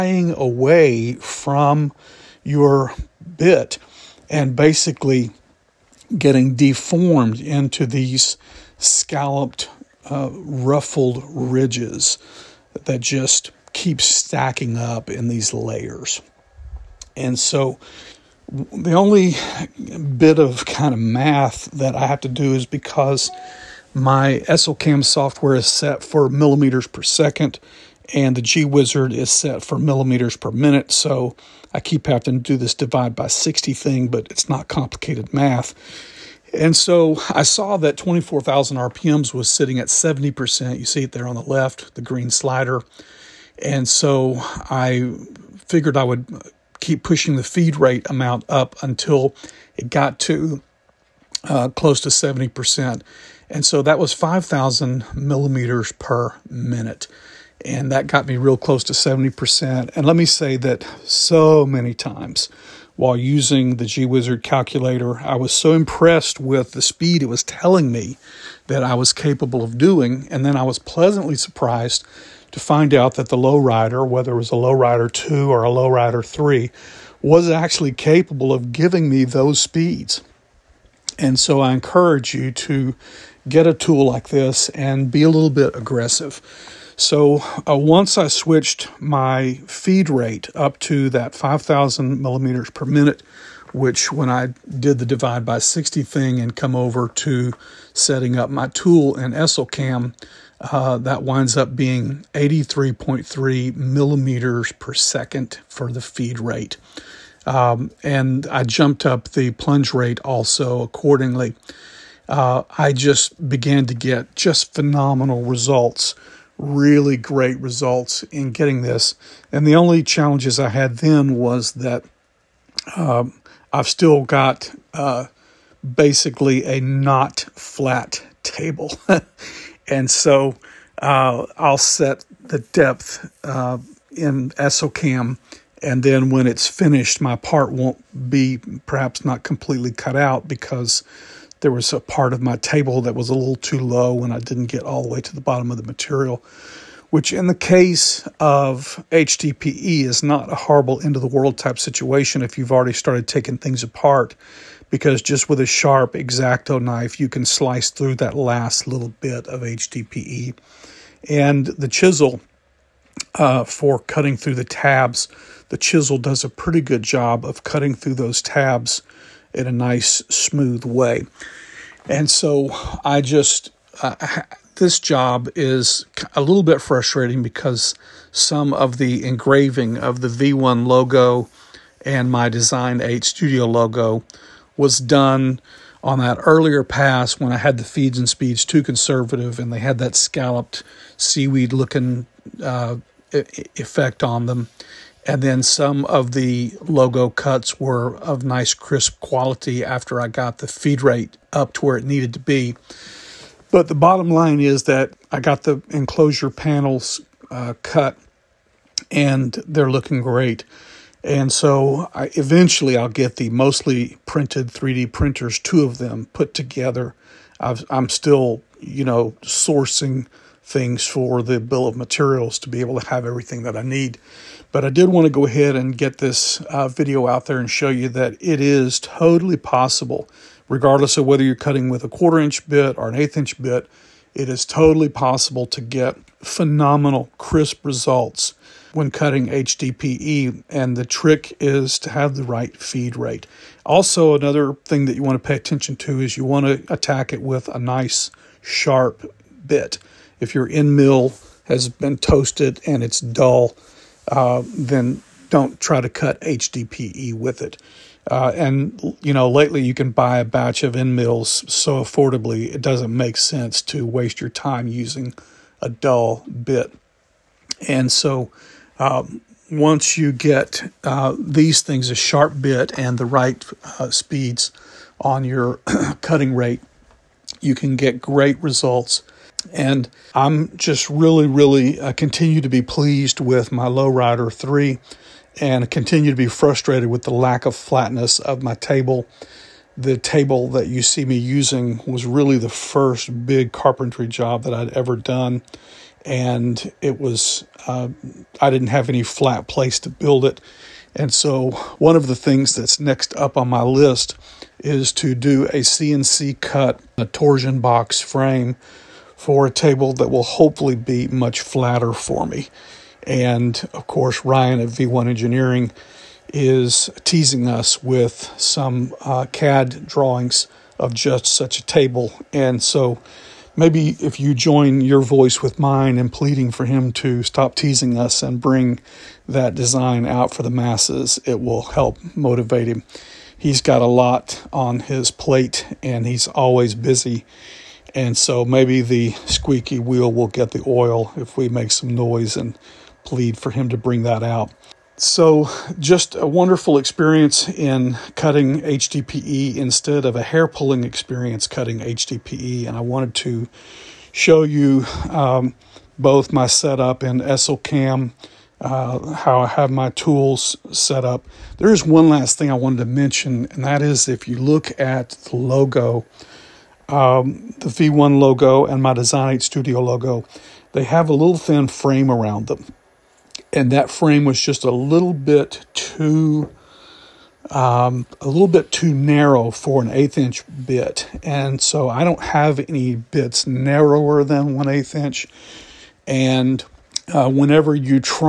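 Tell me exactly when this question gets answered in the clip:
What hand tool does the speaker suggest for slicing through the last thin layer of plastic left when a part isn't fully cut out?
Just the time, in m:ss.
2:36.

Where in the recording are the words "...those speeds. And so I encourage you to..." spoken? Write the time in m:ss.
1:19.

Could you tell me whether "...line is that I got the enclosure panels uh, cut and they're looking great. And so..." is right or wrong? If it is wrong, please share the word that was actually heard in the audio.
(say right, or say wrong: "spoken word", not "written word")
right.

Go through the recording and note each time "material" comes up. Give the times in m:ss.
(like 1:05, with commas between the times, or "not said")
2:25, 3:41.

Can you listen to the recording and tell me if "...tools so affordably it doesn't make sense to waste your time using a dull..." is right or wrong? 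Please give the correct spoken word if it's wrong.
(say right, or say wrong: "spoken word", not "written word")
wrong: "mills", not "tools".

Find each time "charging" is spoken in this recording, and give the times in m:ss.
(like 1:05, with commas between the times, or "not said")
not said.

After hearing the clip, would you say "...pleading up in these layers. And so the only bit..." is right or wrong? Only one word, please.
wrong.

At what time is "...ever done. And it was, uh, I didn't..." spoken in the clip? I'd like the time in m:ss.
4:54.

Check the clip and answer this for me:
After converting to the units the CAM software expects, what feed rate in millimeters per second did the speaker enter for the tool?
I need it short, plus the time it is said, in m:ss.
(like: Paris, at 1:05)
83.3, at 1:42.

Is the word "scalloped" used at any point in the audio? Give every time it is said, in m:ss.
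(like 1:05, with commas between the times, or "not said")
0:08, 3:10.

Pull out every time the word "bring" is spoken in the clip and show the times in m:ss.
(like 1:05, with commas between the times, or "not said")
5:28, 5:43.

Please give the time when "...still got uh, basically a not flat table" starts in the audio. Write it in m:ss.
2:03.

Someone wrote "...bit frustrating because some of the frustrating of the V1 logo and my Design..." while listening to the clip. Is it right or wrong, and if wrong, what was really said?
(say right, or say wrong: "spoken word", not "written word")
wrong: "engraving", not "frustrating".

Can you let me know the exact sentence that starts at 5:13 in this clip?
And of course, Ryan of V1 Engineering is teasing us with some uh, CAD drawings of just such a table.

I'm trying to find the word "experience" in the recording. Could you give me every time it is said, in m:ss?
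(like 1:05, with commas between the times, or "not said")
5:46, 5:51.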